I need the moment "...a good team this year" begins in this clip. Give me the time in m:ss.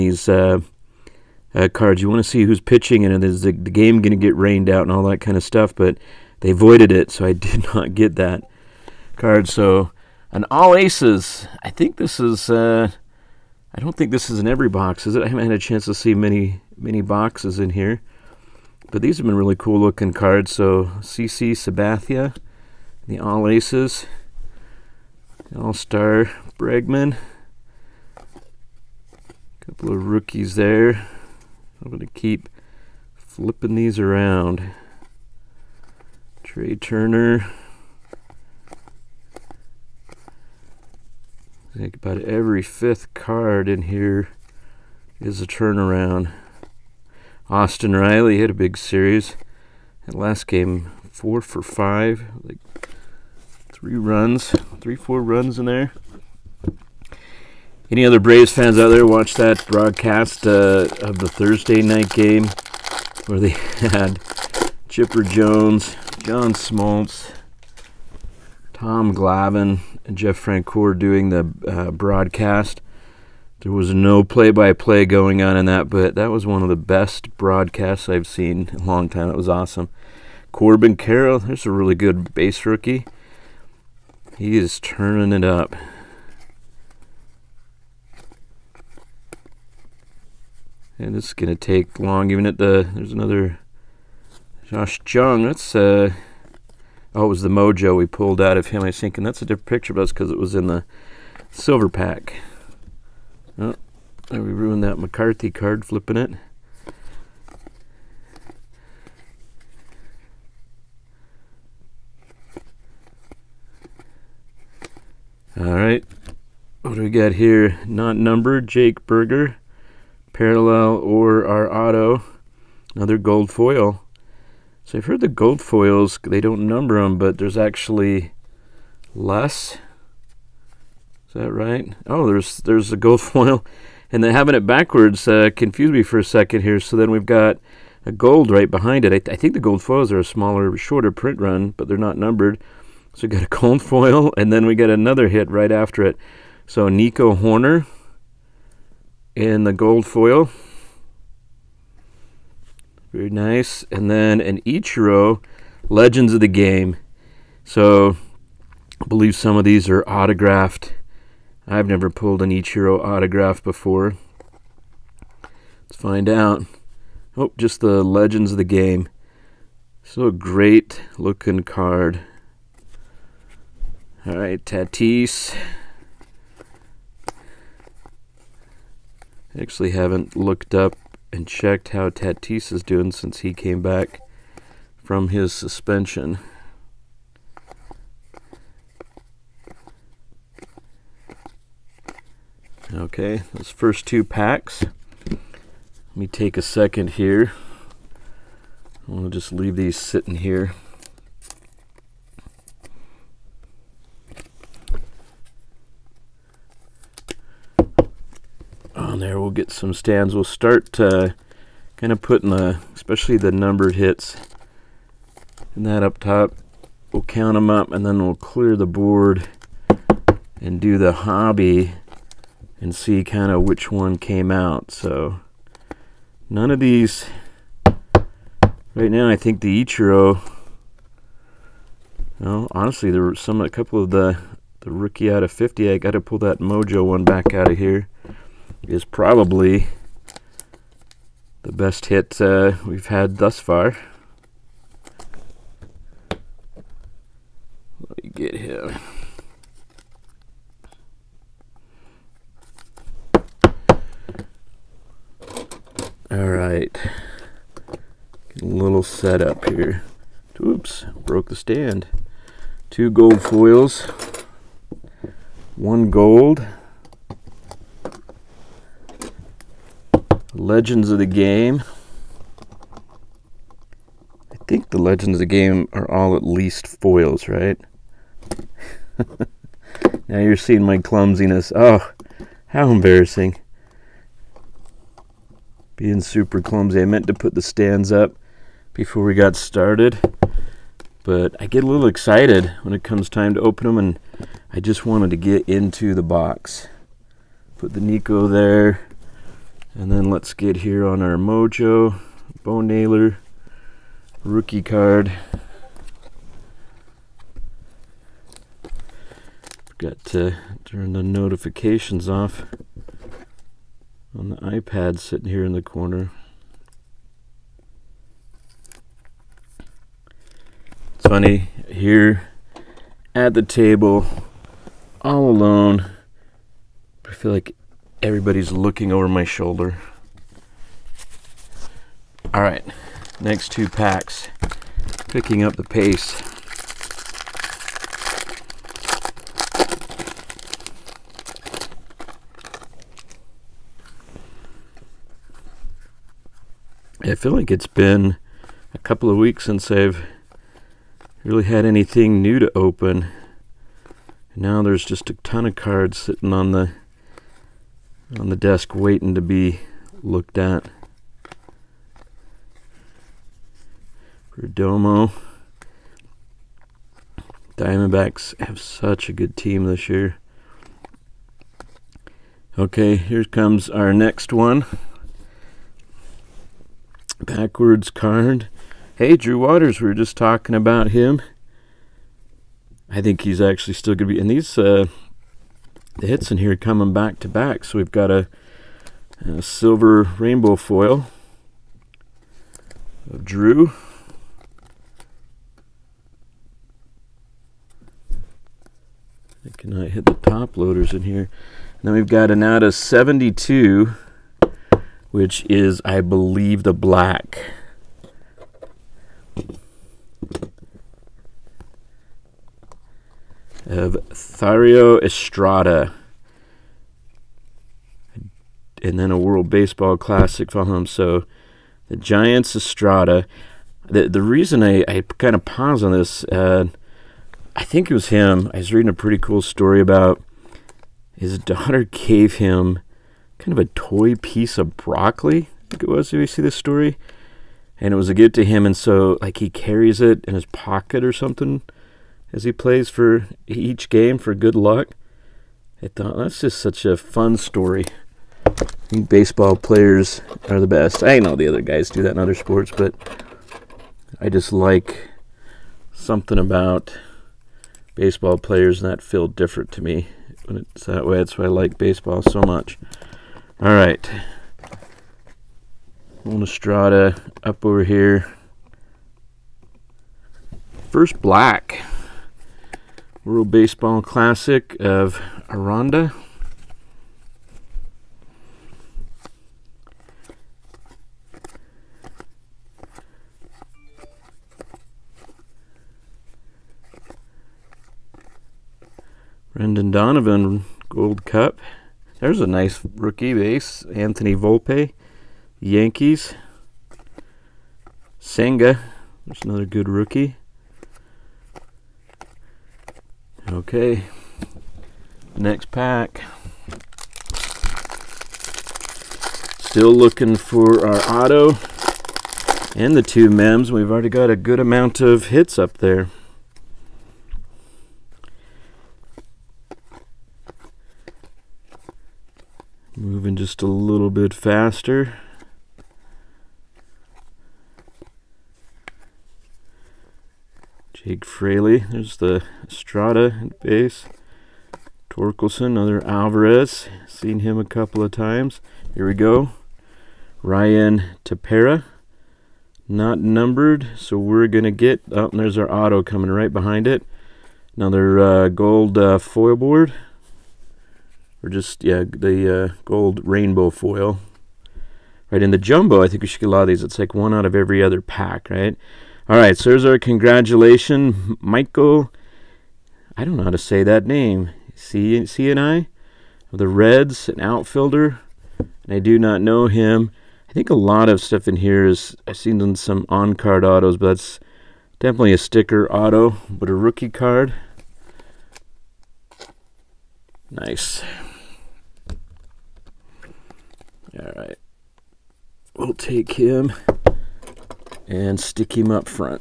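6:09.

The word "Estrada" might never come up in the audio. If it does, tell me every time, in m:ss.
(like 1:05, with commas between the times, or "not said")
6:55, 7:02, 8:52.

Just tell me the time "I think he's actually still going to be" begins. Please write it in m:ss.
6:23.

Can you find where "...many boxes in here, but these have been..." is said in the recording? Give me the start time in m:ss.
0:16.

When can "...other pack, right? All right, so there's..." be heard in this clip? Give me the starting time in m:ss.
9:18.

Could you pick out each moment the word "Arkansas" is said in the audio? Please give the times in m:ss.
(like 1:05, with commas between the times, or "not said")
not said.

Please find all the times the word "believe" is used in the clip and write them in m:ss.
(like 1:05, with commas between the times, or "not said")
2:39, 6:46.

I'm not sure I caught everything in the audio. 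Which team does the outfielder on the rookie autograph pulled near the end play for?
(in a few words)
the Reds.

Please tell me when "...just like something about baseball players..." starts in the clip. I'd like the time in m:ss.
7:34.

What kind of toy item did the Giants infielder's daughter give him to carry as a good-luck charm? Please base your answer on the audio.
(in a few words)
broccoli.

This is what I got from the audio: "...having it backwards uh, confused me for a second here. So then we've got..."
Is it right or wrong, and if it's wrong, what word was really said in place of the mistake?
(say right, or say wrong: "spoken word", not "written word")
right.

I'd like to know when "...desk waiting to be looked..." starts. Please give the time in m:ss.
5:58.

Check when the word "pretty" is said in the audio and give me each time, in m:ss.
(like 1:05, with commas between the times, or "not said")
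7:09.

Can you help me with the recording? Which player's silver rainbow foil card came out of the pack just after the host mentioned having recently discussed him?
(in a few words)
Drew Waters.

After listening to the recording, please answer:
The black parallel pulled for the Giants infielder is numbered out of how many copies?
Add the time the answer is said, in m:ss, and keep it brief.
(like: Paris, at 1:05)
72, at 6:42.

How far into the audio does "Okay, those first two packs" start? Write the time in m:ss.
3:12.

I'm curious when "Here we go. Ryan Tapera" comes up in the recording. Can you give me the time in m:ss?
8:59.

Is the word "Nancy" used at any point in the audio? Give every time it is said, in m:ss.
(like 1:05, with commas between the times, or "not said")
not said.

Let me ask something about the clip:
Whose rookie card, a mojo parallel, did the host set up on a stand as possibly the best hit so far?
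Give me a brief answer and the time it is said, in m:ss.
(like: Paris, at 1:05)
Bo Naylor, at 5:02.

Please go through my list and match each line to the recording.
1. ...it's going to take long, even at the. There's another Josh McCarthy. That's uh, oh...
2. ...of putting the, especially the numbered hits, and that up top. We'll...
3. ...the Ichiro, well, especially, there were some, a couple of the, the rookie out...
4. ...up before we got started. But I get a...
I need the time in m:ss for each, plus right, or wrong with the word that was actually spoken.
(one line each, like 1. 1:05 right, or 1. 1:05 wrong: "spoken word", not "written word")
1. 1:31 wrong: "Jung", not "McCarthy"
2. 3:32 right
3. 3:49 wrong: "honestly", not "especially"
4. 4:48 right.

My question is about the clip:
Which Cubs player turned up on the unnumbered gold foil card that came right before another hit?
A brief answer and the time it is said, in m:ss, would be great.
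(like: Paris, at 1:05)
Nico Hoerner, at 2:26.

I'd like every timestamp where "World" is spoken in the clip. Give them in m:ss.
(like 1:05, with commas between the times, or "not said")
6:59, 7:53.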